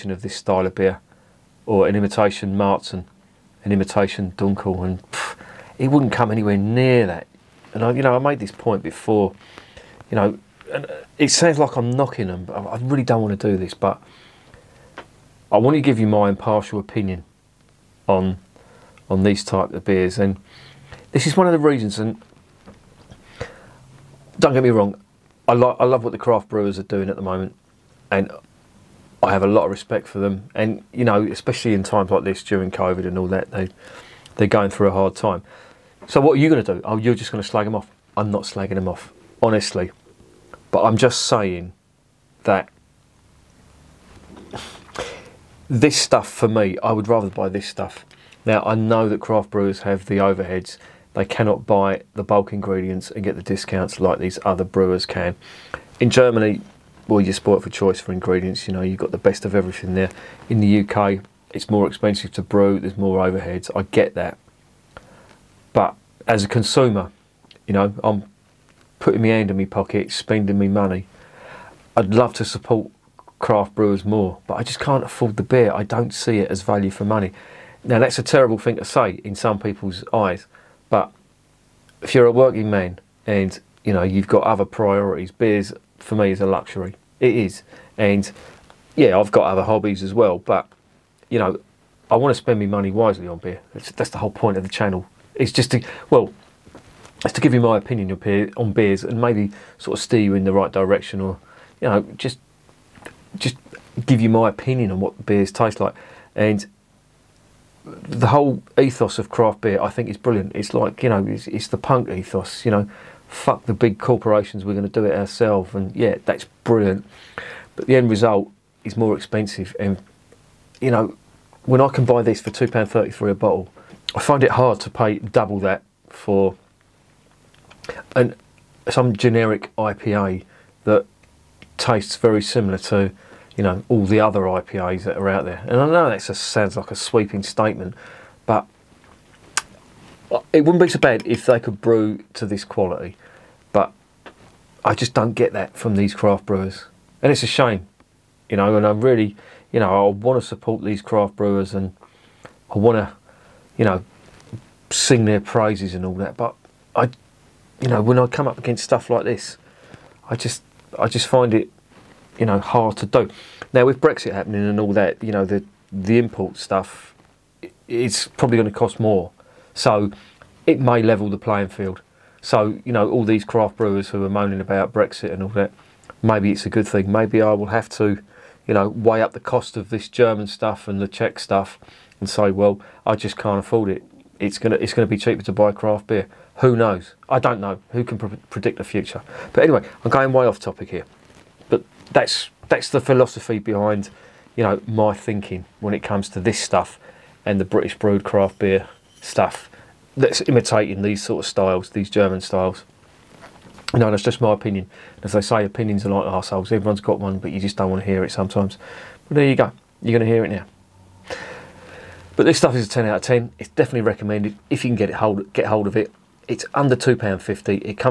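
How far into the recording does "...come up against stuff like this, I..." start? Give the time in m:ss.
2:38.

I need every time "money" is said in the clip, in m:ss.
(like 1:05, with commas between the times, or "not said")
1:10, 1:17, 1:32.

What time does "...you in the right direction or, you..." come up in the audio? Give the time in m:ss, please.
1:40.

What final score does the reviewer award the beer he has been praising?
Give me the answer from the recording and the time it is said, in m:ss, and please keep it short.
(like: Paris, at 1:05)
10 out of 10, at 3:32.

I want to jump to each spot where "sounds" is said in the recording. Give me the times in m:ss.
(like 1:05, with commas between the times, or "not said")
0:11, 2:16.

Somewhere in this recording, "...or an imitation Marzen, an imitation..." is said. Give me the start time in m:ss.
0:01.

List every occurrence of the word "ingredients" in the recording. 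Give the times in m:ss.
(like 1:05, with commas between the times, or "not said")
0:52, 0:58.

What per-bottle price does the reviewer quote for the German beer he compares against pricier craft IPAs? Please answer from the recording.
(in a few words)
£2.33.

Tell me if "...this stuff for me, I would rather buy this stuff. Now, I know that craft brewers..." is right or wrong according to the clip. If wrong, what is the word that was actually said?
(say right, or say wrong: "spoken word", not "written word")
right.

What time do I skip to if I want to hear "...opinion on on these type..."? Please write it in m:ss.
0:16.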